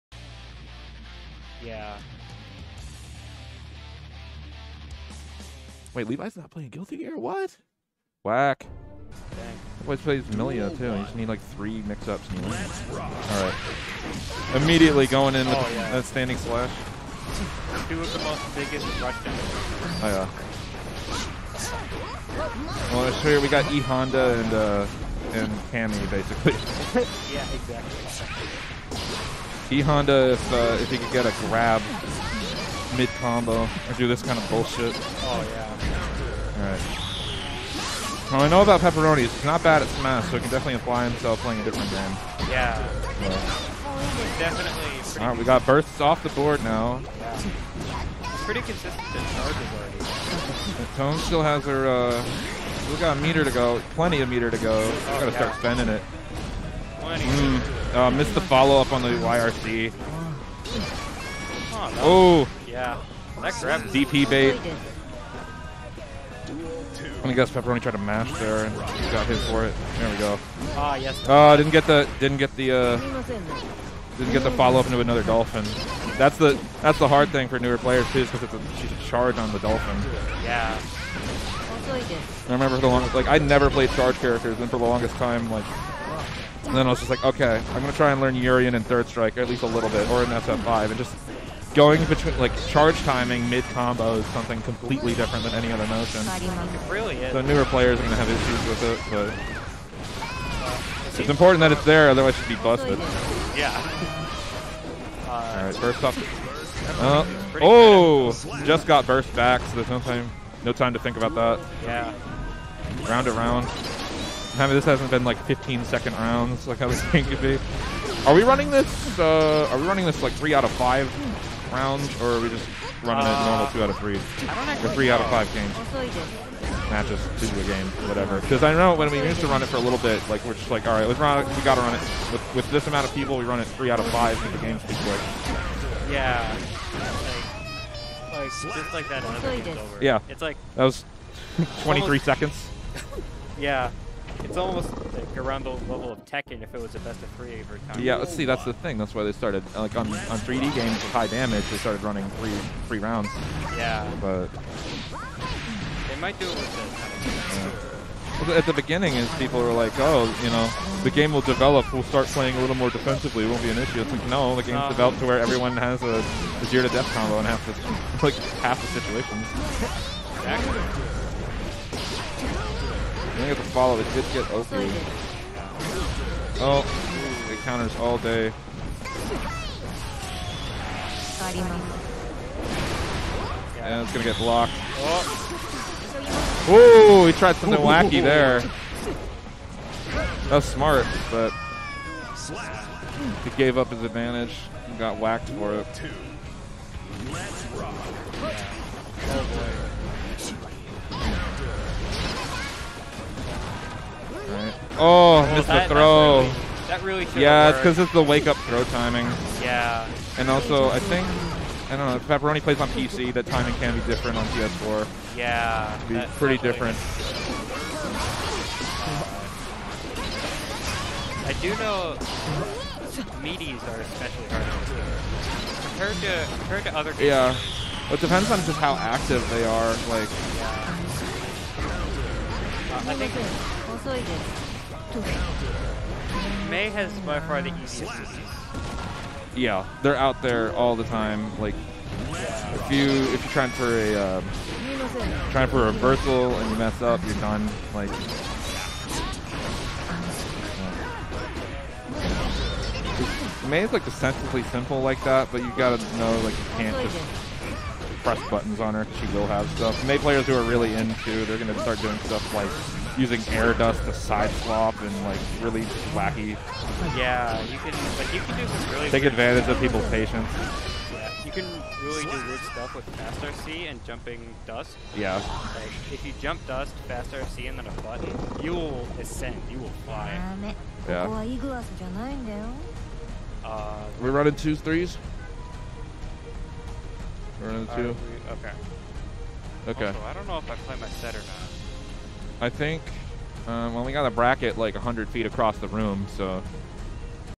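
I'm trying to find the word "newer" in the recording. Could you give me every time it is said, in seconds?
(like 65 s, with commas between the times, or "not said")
77 s, 97 s.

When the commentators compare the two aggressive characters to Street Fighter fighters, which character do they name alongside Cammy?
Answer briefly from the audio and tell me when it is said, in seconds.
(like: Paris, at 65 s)
E Honda, at 23 s.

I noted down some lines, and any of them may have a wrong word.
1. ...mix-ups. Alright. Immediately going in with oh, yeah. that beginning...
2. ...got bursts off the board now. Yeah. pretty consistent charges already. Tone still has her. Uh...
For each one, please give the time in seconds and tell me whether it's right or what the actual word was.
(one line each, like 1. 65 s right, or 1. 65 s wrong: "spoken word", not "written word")
1. 11 s wrong: "standing", not "beginning"
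2. 45 s right.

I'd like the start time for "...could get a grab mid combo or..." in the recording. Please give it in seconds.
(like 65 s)
30 s.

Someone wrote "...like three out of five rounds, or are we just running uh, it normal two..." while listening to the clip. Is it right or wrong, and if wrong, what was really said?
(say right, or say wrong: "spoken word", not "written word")
right.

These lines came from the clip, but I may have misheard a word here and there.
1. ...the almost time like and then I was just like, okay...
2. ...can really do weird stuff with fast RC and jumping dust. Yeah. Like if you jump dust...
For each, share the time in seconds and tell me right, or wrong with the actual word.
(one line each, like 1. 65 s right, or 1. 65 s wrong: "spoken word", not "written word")
1. 84 s wrong: "longest", not "almost"
2. 271 s right.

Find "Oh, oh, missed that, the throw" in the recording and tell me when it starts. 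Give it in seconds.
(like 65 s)
204 s.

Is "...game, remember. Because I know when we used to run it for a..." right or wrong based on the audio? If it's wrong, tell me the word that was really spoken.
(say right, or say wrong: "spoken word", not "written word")
wrong: "whatever", not "remember".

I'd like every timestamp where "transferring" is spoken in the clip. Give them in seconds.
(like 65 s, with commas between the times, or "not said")
not said.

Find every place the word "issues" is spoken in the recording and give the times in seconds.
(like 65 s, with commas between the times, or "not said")
98 s, 163 s.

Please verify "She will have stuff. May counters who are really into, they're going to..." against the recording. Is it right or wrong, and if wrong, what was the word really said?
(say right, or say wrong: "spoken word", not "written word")
wrong: "players", not "counters".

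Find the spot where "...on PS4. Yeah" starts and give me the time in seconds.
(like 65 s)
214 s.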